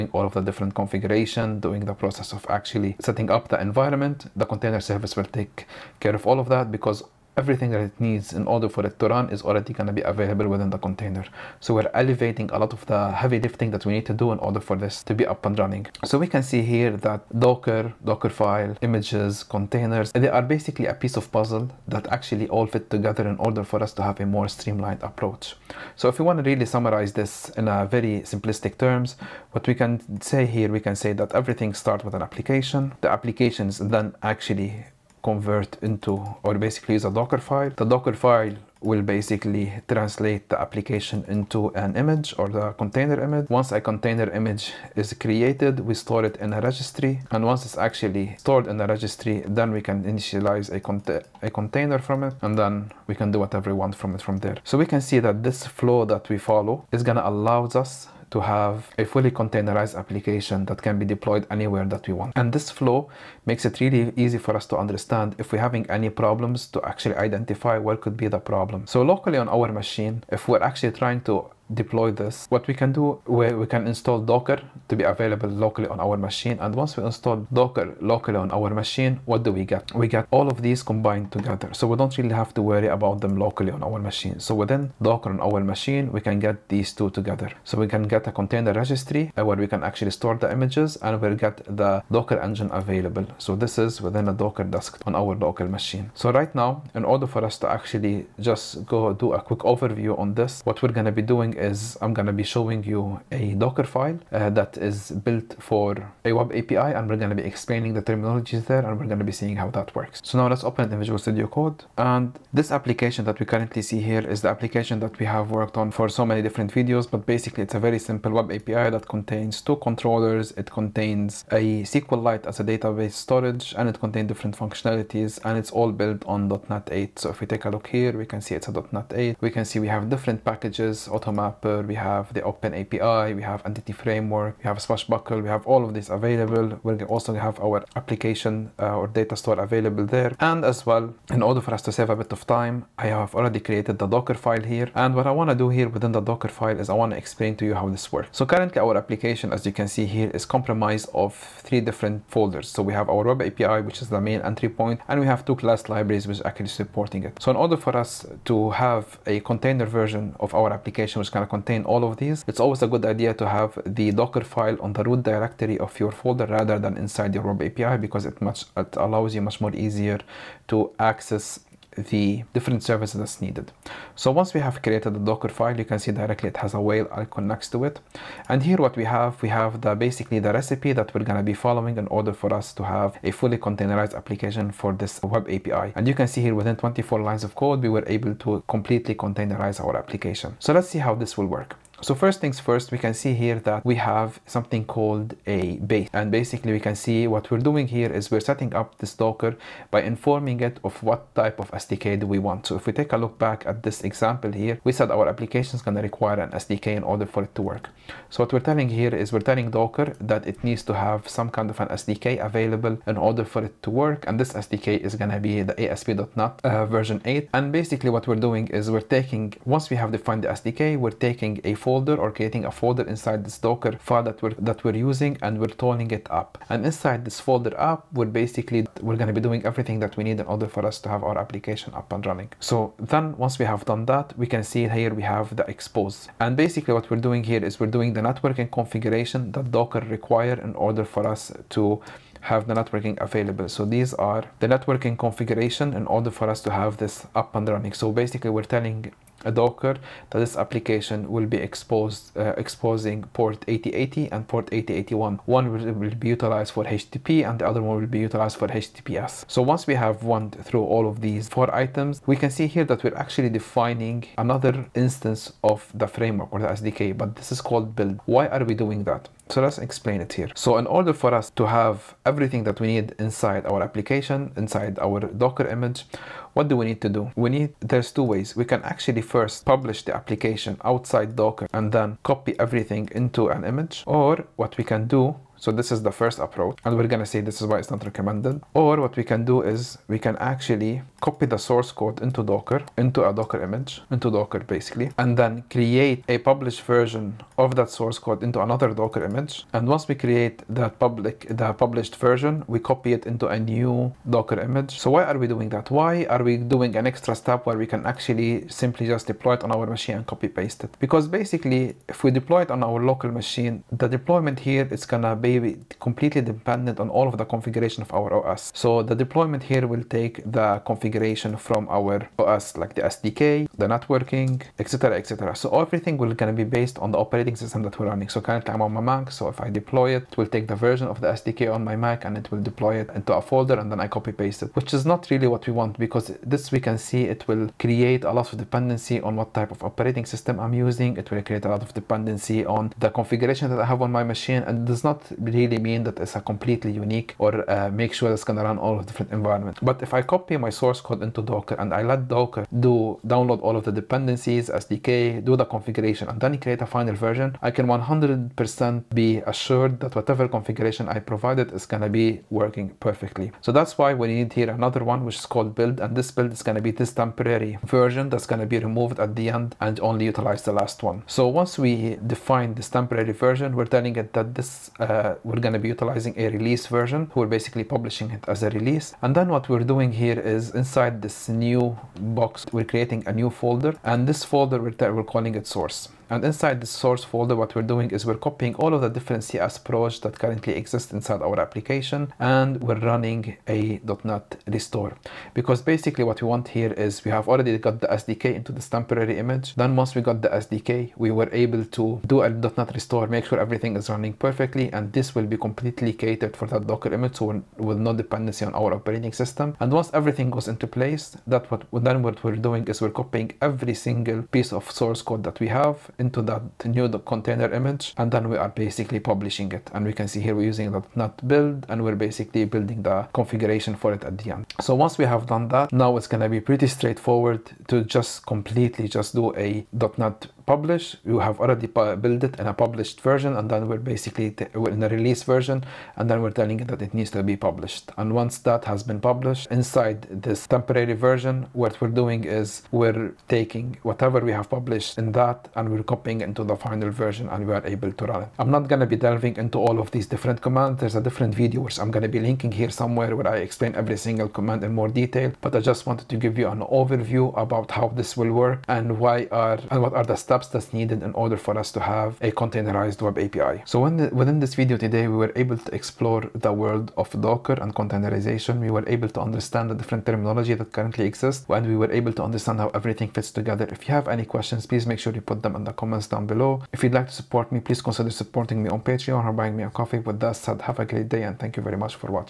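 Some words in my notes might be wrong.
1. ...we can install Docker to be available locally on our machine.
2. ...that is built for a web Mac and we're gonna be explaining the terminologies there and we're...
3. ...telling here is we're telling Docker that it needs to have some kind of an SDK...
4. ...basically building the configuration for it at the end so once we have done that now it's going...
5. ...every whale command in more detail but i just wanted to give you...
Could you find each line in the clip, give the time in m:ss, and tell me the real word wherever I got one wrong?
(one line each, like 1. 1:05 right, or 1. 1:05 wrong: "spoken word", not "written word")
1. 1:13 right
2. 1:44 wrong: "API", not "Mac"
3. 3:28 right
4. 7:02 right
5. 7:34 wrong: "single", not "whale".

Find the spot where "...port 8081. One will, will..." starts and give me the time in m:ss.
4:14.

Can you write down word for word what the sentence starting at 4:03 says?
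So these are the networking configuration in order for us to have this up and running.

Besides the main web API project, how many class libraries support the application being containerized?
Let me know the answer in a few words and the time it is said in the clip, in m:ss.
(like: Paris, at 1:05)
2, at 2:35.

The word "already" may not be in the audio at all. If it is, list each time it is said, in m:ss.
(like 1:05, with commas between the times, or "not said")
0:09, 2:23, 6:37, 7:11.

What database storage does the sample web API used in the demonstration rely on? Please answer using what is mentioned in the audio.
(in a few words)
SQLite.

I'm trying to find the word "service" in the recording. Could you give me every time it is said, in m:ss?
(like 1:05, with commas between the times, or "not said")
0:04, 2:52.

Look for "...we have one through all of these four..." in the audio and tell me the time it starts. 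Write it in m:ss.
4:19.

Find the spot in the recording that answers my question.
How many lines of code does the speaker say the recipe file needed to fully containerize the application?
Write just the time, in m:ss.
3:06.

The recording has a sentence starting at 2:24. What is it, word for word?
And what I want to do here within the Docker file is I want to explain to you how this works.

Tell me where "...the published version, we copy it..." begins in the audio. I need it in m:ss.
5:01.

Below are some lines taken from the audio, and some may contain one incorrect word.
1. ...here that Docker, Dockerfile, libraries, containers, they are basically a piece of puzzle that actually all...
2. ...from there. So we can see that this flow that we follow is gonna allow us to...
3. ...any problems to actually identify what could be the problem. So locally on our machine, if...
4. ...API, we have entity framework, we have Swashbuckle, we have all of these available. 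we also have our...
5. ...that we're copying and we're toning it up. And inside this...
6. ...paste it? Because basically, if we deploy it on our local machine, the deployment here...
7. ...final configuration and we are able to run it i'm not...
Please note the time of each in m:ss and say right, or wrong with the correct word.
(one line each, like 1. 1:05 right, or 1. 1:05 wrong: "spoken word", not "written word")
1. 0:16 wrong: "images", not "libraries"
2. 0:54 right
3. 1:05 right
4. 2:12 right
5. 3:44 wrong: "using", not "copying"
6. 5:10 right
7. 7:26 wrong: "version", not "configuration".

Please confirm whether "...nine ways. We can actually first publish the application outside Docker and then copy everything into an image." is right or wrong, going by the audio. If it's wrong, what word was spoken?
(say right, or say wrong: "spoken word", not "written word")
wrong: "two", not "nine".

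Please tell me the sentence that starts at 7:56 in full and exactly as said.
If you'd like to support me, please consider supporting me on Patreon or buying me a coffee.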